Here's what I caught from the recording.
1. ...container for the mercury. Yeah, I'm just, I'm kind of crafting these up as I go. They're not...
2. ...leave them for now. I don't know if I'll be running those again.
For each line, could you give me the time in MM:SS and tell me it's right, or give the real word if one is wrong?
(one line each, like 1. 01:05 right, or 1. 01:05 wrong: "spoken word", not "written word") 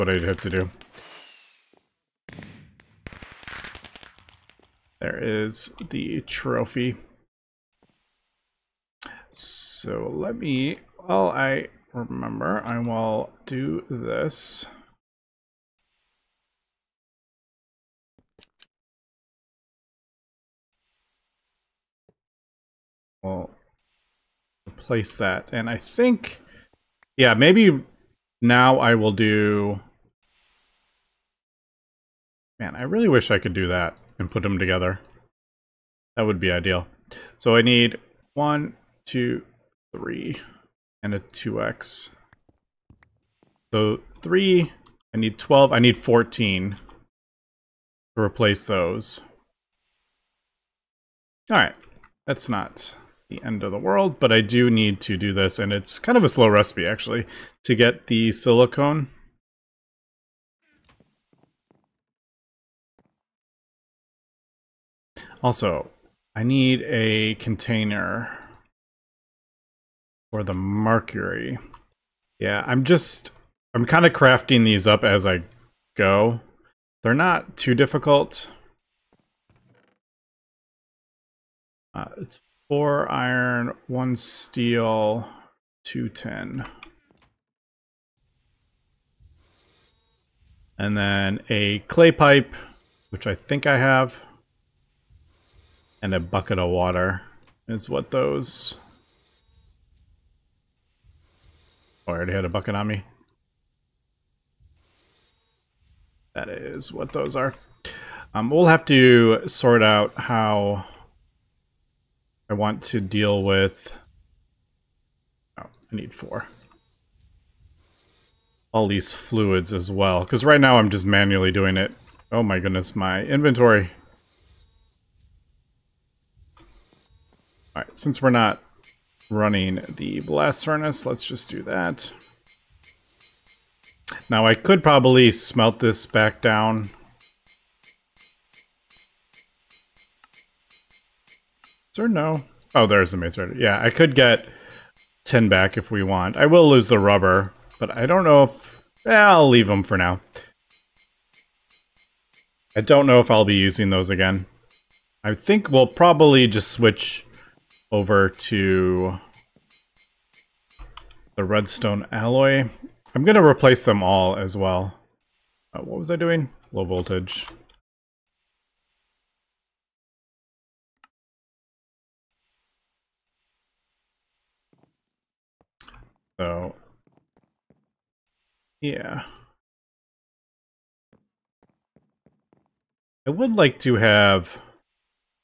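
1. 01:07 right
2. 02:29 wrong: "using", not "running".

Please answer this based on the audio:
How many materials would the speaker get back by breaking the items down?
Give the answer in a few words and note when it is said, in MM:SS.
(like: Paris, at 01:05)
10, at 02:25.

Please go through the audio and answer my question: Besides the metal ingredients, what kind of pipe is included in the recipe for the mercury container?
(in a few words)
clay pipe.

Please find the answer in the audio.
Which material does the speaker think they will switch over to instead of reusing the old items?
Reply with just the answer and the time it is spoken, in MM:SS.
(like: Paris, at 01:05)
redstone alloy, at 02:41.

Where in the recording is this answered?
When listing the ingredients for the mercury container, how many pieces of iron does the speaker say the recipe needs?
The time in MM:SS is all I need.
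01:22.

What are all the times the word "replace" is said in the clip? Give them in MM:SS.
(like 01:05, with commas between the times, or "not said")
00:24, 00:48, 02:43.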